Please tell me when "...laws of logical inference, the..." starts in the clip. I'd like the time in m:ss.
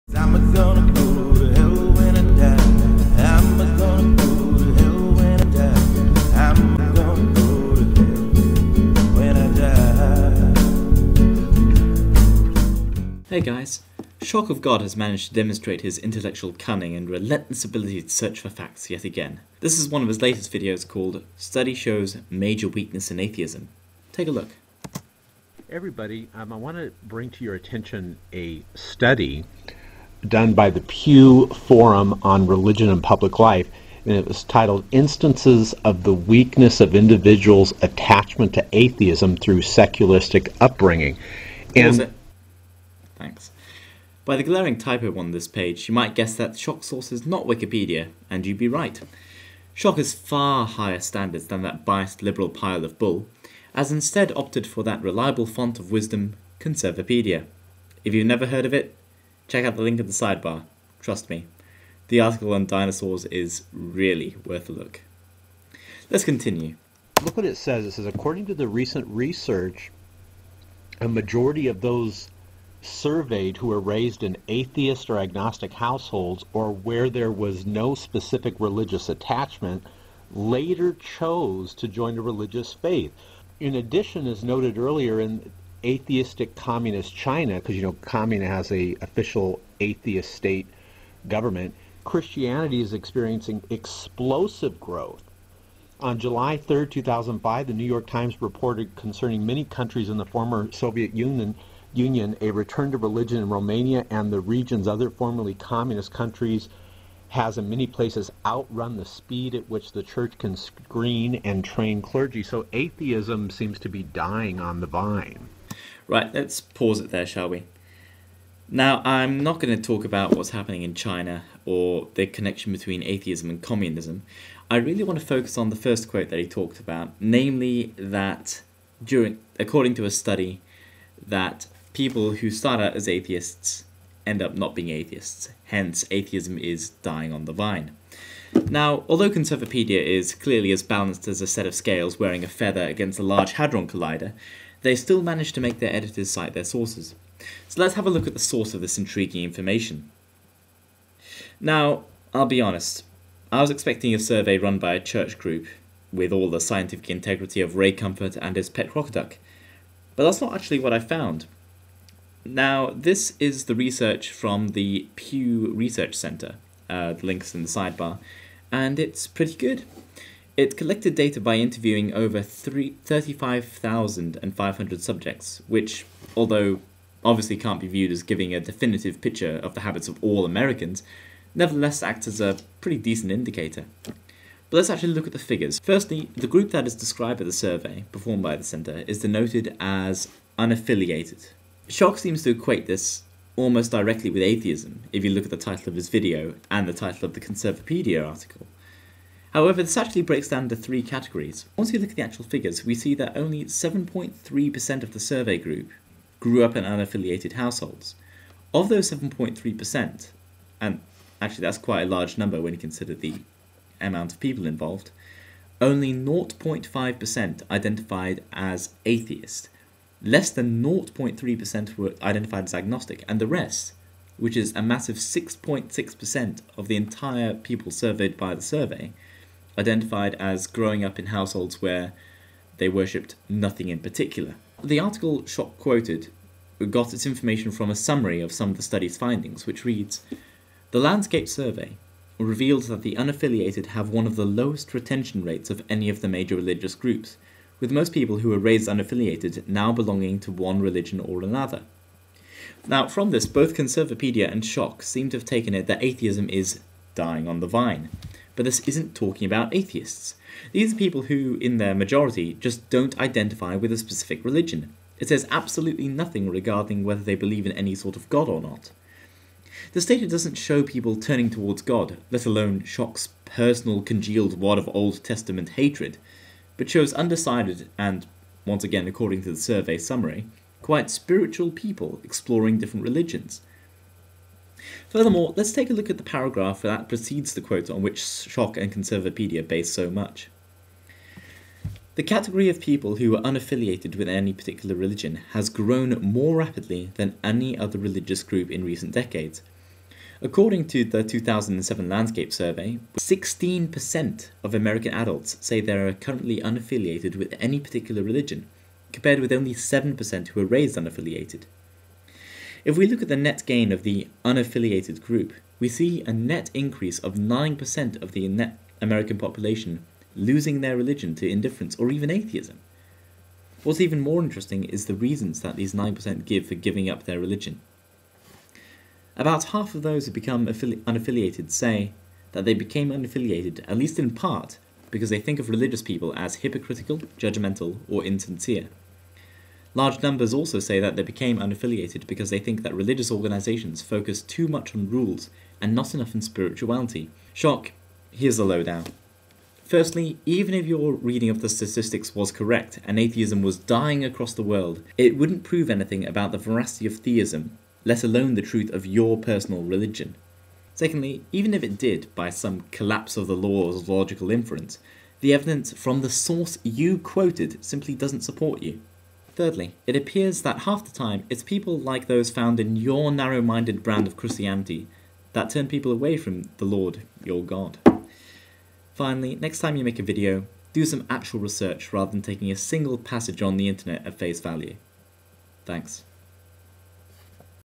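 6:03.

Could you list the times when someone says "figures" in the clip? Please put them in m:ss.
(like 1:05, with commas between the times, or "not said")
3:05, 3:22.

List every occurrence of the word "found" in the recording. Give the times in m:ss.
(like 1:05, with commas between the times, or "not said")
2:40, 6:12.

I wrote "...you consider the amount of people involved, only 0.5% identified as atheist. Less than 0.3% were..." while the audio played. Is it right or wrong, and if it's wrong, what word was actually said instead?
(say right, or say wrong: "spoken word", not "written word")
right.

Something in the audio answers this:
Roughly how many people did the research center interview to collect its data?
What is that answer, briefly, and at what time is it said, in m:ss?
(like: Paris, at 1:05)
35,500, at 2:52.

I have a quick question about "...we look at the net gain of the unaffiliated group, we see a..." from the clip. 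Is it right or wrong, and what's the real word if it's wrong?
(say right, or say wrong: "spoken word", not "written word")
right.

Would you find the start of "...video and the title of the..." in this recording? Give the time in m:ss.
3:16.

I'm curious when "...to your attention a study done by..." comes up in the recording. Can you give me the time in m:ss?
0:27.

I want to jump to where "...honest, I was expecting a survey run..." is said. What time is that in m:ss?
2:32.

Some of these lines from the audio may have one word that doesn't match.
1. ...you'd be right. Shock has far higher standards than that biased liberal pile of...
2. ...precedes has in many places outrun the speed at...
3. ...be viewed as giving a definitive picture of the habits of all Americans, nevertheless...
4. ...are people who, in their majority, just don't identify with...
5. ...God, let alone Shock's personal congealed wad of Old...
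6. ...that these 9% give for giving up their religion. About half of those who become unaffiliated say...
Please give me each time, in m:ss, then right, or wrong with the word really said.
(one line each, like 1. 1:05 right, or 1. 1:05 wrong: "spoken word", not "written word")
1. 0:48 right
2. 1:46 wrong: "countries", not "precedes"
3. 2:57 right
4. 4:20 right
5. 4:31 right
6. 5:25 right.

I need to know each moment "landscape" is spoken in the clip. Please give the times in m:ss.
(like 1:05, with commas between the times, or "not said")
4:00, 5:02.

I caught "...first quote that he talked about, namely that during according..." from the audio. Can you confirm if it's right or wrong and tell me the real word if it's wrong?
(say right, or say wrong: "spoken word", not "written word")
right.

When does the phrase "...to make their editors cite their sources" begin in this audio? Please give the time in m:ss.
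2:25.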